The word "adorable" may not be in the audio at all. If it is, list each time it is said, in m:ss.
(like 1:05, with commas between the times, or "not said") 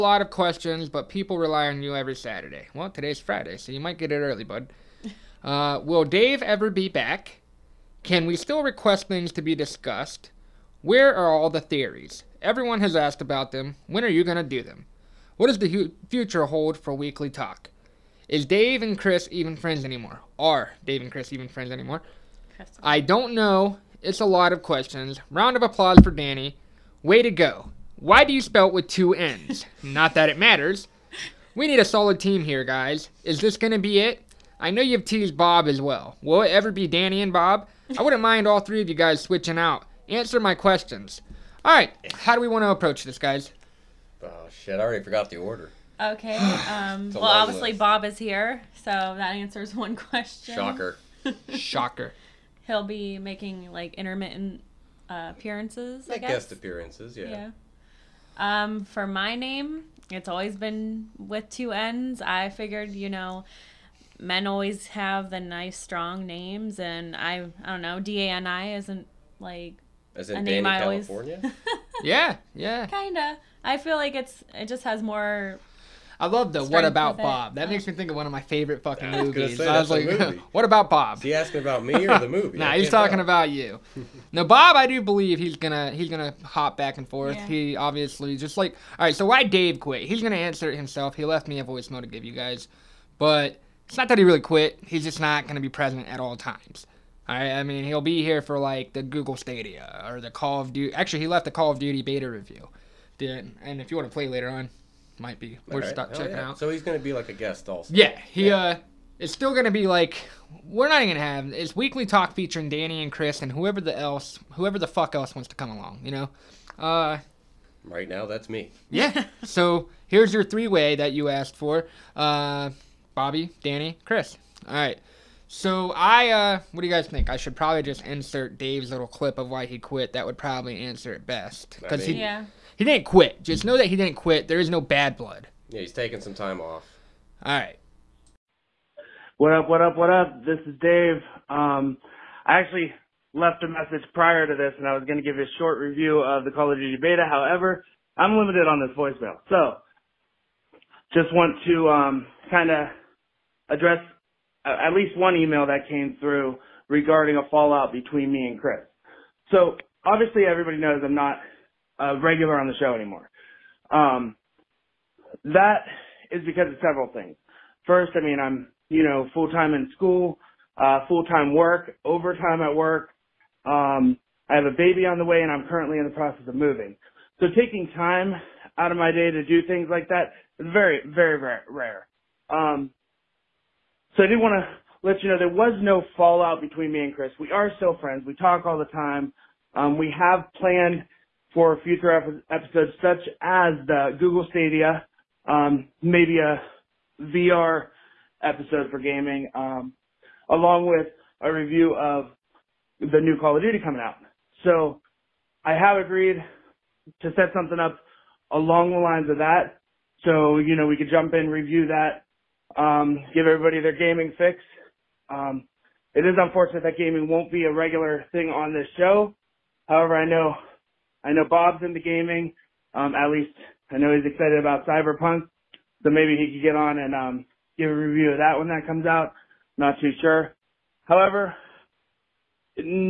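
not said.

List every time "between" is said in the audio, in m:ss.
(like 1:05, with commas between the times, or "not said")
2:37, 3:06.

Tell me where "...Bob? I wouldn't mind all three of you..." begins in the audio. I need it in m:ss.
0:37.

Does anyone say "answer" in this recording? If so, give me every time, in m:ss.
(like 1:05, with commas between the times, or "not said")
0:40, 0:49, 1:30, 2:10.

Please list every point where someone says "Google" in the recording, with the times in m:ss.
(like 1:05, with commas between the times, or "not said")
1:39, 3:14.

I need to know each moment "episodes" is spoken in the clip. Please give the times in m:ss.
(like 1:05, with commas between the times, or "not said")
3:12, 3:18.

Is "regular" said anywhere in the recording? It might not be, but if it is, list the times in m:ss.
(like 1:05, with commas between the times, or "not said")
2:42, 3:37.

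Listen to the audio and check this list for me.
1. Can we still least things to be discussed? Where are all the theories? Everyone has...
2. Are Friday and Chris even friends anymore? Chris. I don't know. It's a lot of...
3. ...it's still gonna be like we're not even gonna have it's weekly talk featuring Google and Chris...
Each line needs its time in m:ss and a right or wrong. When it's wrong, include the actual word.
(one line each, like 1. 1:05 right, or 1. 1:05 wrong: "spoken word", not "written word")
1. 0:08 wrong: "request", not "least"
2. 0:20 wrong: "Dave", not "Friday"
3. 1:49 wrong: "Danny", not "Google".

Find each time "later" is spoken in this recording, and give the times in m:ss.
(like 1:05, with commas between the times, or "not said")
1:44.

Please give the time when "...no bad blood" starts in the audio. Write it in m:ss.
2:14.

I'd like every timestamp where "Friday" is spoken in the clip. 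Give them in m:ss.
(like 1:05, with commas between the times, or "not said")
0:03.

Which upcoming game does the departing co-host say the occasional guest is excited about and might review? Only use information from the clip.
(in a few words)
Cyberpunk.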